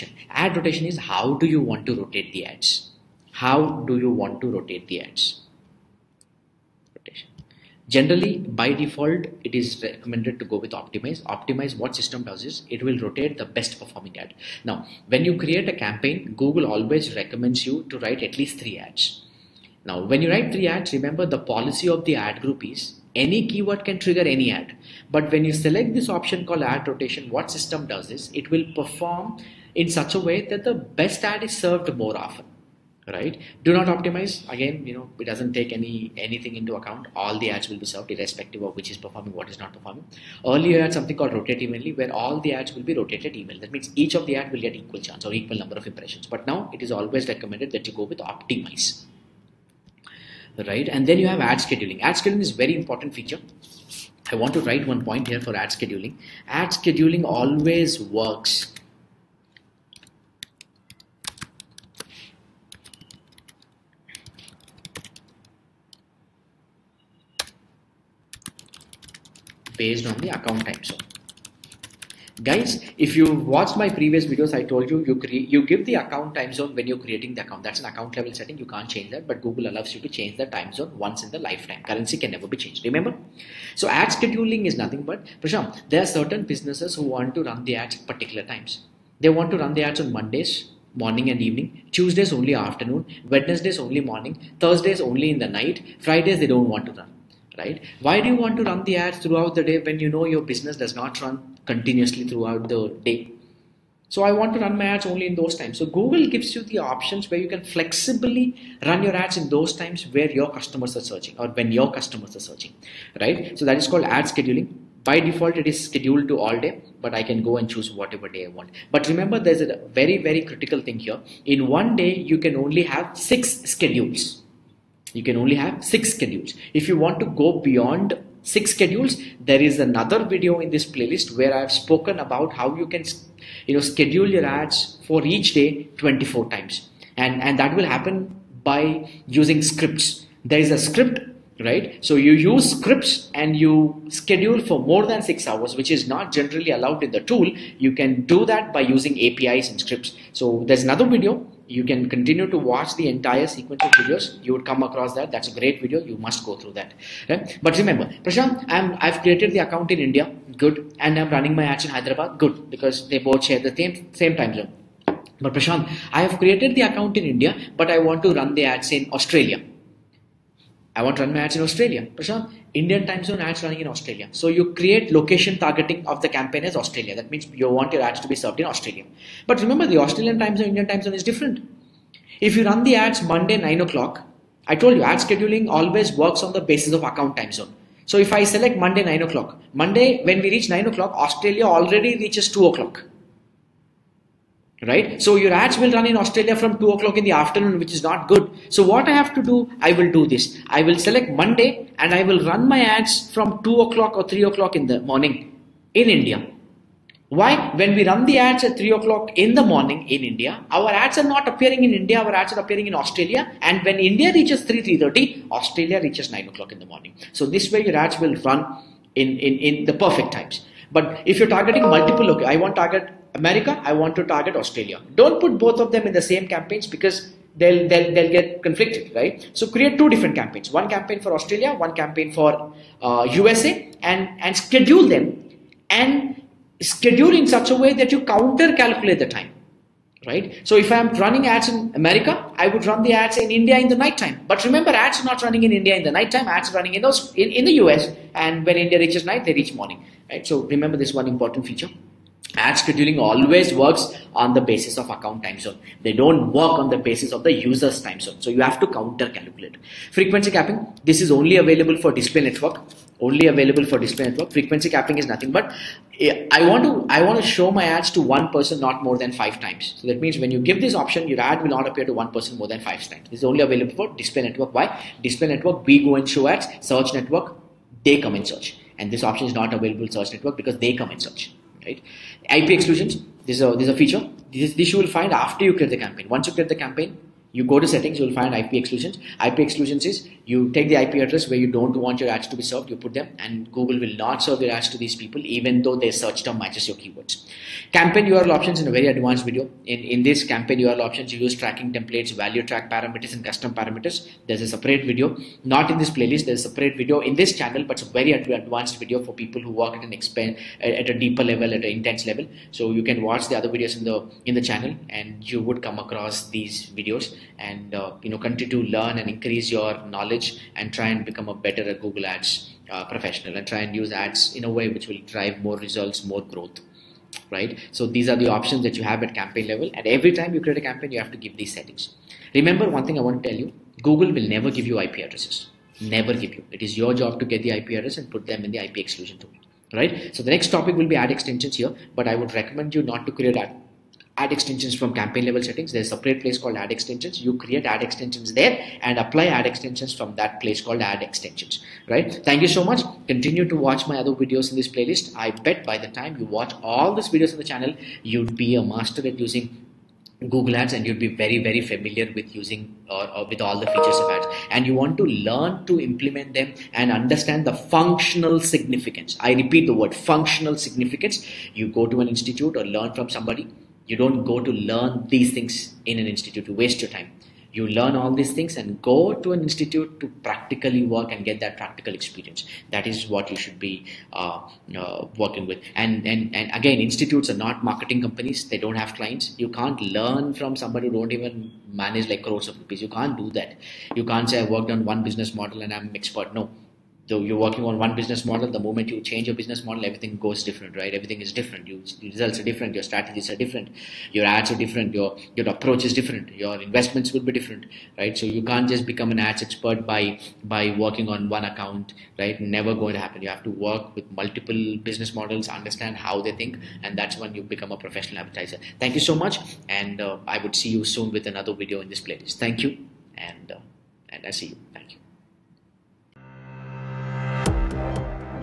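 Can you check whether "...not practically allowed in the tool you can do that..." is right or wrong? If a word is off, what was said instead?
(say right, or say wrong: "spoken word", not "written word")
wrong: "generally", not "practically".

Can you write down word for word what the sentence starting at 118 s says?
But remember, there's a very, very critical thing here.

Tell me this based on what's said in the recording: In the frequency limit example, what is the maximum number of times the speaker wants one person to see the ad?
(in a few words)
5.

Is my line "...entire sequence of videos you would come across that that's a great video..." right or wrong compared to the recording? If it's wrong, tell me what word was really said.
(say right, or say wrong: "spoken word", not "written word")
right.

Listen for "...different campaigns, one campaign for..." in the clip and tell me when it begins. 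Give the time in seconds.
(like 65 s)
230 s.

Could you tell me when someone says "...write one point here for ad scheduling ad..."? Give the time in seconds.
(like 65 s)
54 s.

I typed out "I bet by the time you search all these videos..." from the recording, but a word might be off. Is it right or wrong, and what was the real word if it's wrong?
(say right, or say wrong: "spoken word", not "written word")
wrong: "watch", not "search".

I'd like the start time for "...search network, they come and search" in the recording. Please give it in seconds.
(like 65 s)
276 s.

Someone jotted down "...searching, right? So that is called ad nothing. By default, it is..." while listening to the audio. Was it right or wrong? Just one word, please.
wrong.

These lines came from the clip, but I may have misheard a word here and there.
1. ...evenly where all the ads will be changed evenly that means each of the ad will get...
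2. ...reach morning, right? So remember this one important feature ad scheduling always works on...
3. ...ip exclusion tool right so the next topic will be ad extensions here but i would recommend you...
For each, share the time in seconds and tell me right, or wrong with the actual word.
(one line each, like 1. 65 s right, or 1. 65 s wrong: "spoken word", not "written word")
1. 41 s wrong: "rotated", not "changed"
2. 249 s right
3. 338 s right.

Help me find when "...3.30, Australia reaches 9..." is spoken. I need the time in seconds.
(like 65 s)
214 s.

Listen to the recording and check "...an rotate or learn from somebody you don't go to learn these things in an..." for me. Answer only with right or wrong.
wrong.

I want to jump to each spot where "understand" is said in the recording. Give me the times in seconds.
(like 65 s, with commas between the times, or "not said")
367 s, 415 s.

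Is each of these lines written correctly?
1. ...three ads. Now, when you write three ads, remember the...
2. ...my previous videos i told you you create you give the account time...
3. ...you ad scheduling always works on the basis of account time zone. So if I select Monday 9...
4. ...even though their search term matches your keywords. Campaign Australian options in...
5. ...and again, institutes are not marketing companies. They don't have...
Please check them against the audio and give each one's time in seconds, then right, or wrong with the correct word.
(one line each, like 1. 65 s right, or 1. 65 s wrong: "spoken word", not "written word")
1. 18 s right
2. 73 s right
3. 184 s right
4. 295 s wrong: "URL", not "Australian"
5. 386 s right.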